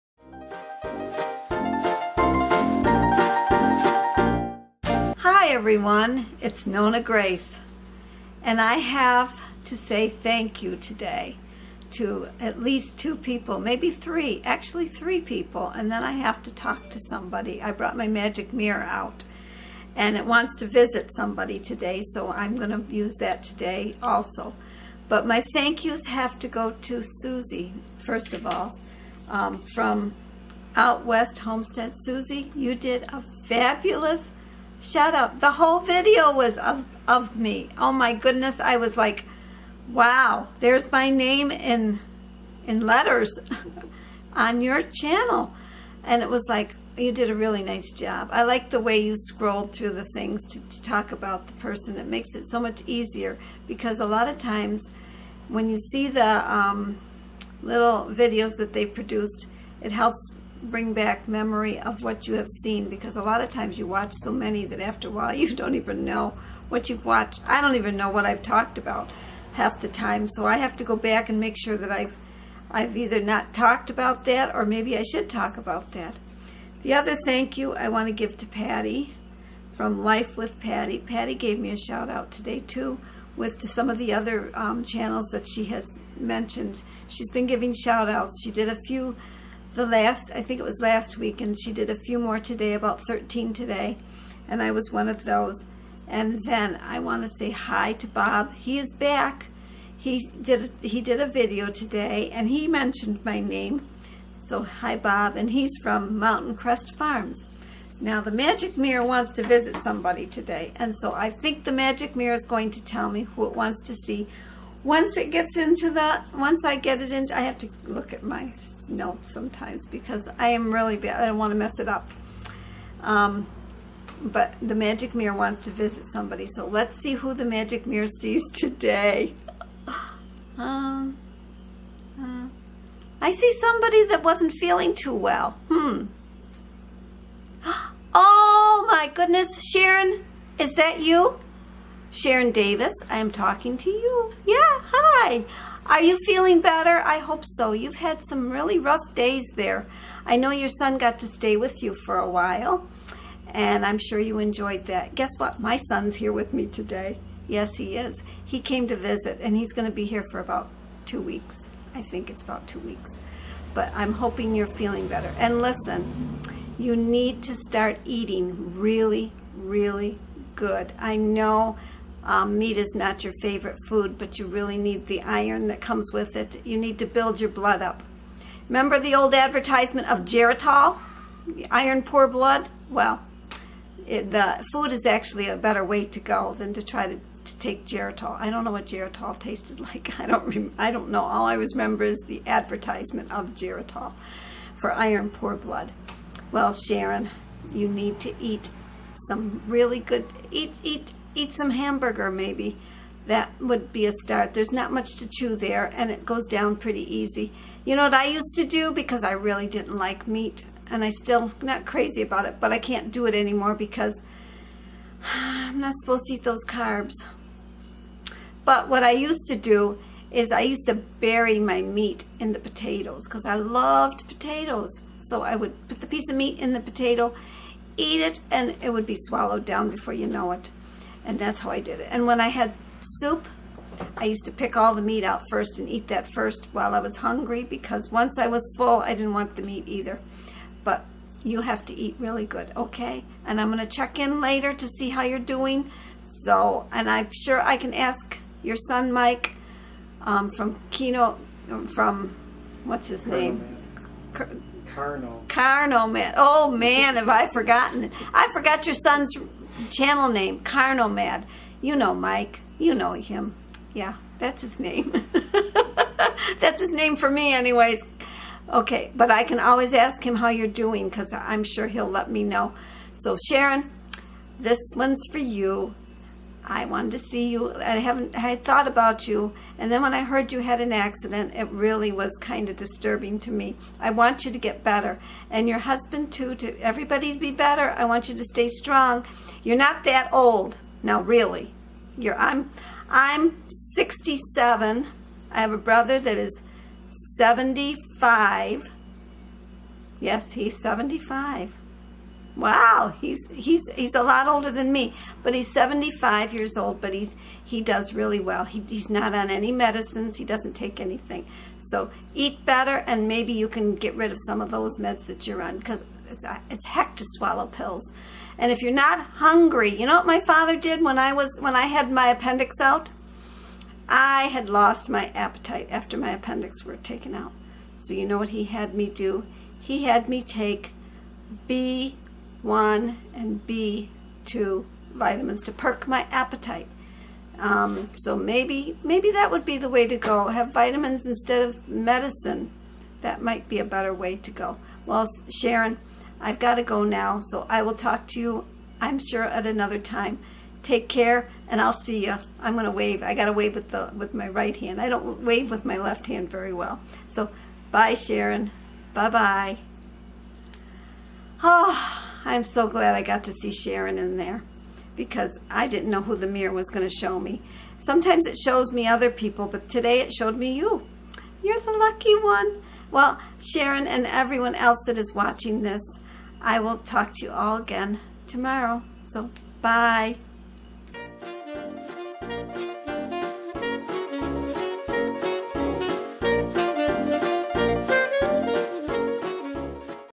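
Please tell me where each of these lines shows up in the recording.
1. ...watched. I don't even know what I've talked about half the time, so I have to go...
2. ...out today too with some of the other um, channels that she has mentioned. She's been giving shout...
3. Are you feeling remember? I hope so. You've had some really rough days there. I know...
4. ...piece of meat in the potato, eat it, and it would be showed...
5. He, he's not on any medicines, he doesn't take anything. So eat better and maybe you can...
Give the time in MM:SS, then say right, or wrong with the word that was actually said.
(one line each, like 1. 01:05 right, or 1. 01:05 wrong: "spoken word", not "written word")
1. 01:07 right
2. 01:22 right
3. 02:25 wrong: "better", not "remember"
4. 03:46 wrong: "swallowed", not "showed"
5. 05:08 right.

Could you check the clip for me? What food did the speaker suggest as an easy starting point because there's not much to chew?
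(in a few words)
hamburger.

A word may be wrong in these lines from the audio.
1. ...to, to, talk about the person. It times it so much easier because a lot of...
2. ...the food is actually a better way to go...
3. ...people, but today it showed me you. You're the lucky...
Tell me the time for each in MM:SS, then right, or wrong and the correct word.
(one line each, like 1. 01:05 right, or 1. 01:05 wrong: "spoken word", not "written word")
1. 00:50 wrong: "makes", not "times"
2. 03:04 right
3. 06:09 right.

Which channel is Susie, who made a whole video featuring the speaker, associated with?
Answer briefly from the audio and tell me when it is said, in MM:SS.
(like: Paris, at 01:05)
Out West Homestead, at 00:30.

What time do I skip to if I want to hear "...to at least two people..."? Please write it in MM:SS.
00:11.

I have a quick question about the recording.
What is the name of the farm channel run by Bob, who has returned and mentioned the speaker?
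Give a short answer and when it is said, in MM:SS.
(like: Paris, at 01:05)
Mountain Crest Farms, at 01:46.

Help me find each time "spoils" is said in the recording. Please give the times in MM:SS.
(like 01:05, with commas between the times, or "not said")
not said.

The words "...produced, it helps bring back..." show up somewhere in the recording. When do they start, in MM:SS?
00:58.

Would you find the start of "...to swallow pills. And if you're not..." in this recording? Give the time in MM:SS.
05:17.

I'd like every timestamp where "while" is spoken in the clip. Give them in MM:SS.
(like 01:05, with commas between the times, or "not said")
01:05, 02:32, 03:56.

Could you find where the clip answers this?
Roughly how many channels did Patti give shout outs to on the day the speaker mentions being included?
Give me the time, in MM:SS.
01:33.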